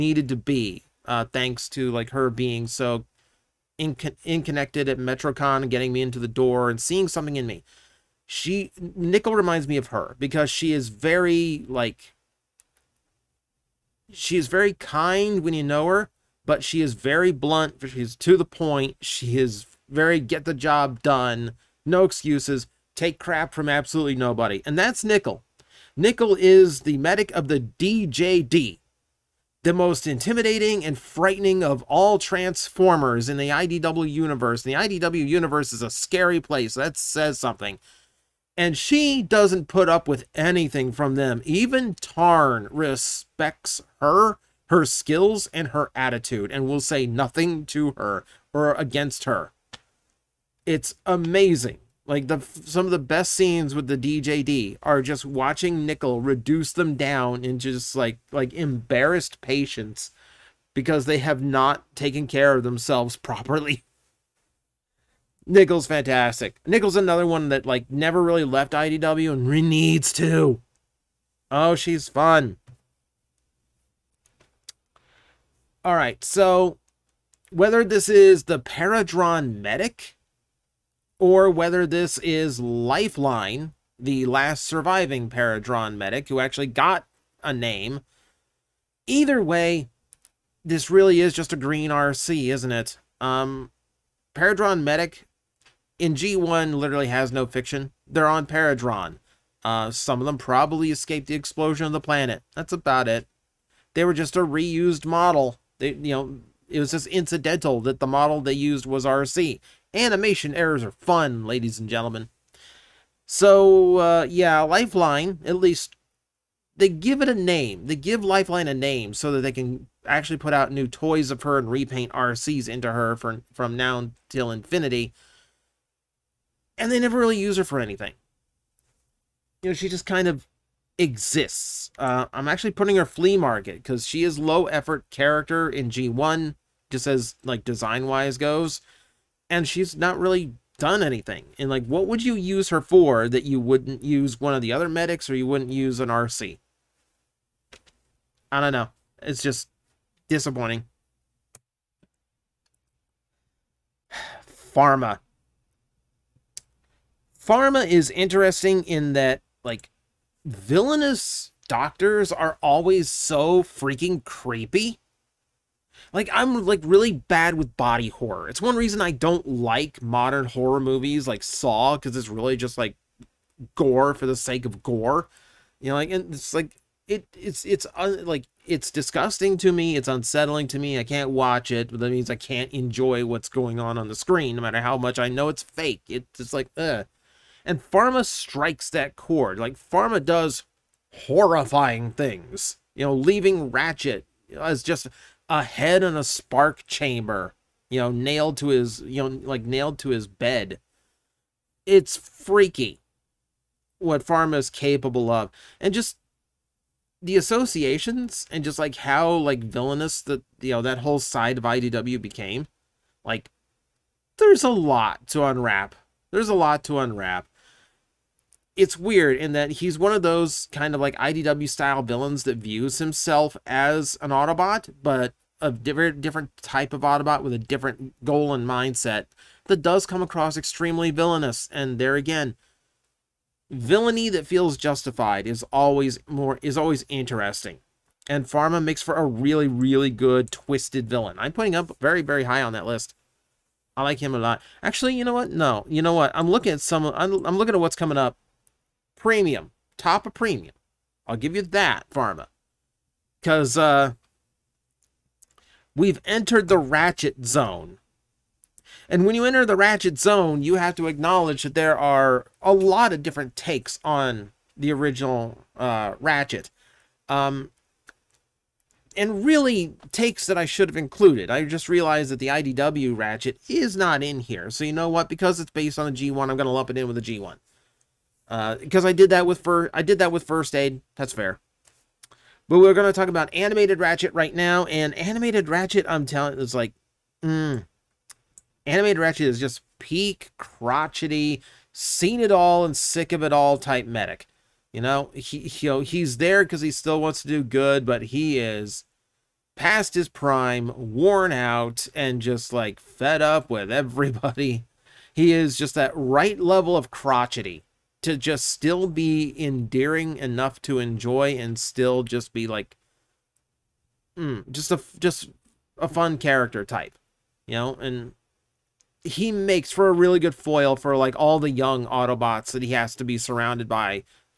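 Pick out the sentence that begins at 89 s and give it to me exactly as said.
Either way, this really is just a green RC, isn't it?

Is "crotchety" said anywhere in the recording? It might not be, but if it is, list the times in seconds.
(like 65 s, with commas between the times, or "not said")
290 s, 307 s.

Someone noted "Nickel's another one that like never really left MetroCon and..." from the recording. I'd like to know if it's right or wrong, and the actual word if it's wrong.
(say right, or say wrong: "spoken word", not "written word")
wrong: "IDW", not "MetroCon".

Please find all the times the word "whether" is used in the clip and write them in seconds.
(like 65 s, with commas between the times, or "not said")
77 s, 81 s.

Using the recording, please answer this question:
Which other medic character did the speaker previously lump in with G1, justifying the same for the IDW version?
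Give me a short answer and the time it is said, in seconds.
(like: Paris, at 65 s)
First Aid, at 280 s.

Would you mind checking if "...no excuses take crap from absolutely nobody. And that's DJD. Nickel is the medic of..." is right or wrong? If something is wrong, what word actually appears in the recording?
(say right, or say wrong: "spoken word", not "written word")
wrong: "Nickel", not "DJD".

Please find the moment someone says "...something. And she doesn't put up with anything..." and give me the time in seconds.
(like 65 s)
37 s.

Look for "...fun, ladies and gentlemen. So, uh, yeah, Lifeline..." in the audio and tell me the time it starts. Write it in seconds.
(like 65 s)
110 s.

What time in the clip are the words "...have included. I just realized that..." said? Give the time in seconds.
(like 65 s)
270 s.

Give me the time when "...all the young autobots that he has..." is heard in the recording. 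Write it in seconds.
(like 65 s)
321 s.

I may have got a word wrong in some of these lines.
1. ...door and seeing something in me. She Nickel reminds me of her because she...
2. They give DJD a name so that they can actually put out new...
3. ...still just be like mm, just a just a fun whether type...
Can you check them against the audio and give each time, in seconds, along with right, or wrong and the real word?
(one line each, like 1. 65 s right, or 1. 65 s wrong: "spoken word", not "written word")
1. 6 s right
2. 117 s wrong: "Lifeline", not "DJD"
3. 311 s wrong: "character", not "whether".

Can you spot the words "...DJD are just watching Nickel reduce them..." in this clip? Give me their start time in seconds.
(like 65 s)
53 s.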